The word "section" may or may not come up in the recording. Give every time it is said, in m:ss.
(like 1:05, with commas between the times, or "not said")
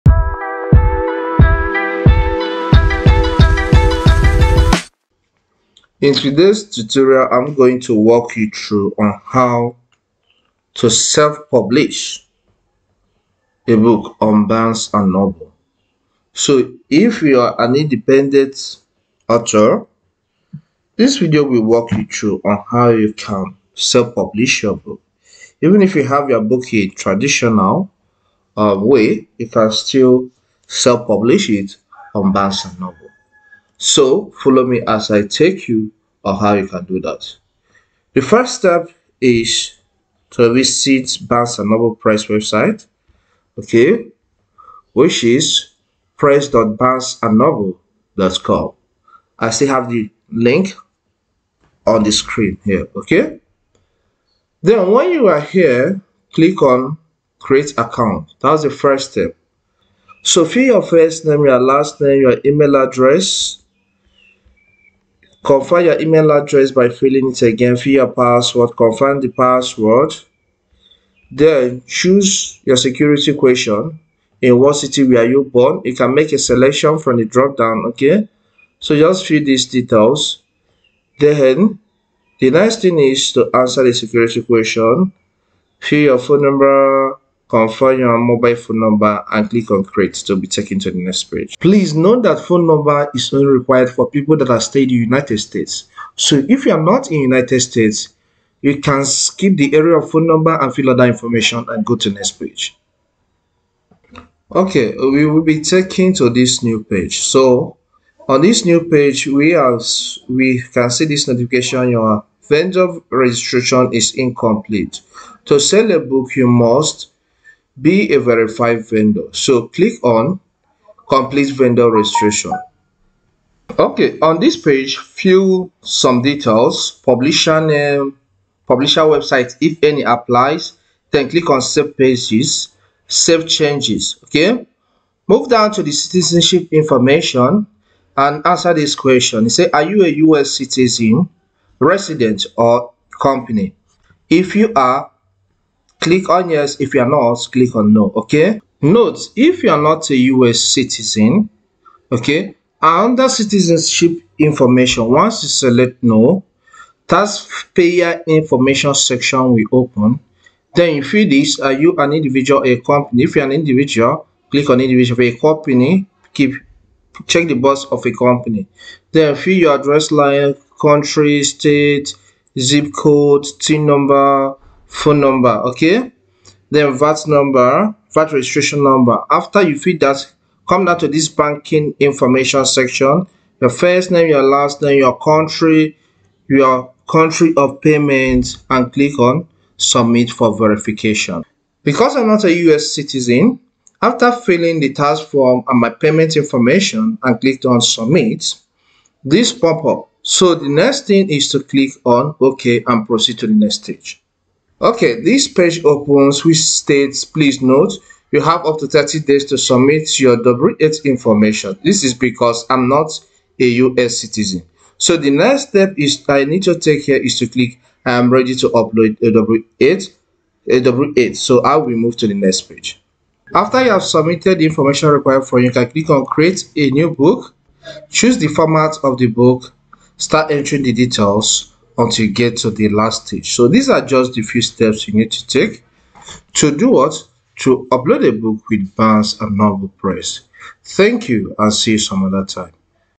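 2:38, 3:02.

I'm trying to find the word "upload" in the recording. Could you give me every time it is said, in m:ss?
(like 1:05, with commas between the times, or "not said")
3:38, 3:57.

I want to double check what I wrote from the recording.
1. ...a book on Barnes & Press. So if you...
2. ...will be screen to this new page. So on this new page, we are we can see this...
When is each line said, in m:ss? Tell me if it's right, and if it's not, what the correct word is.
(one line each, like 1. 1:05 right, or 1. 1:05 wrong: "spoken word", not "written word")
1. 0:13 wrong: "Noble", not "Press"
2. 1:45 wrong: "taken", not "screen".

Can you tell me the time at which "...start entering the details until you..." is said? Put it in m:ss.
3:50.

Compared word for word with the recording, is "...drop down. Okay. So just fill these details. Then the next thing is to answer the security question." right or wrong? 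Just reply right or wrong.
right.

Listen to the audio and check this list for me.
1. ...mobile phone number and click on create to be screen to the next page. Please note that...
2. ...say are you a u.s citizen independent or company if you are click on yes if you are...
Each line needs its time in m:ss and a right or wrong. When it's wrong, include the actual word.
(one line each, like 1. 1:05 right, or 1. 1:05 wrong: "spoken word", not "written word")
1. 1:28 wrong: "taken", not "screen"
2. 2:19 wrong: "resident", not "independent".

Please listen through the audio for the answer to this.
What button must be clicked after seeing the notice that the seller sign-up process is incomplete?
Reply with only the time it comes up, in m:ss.
2:01.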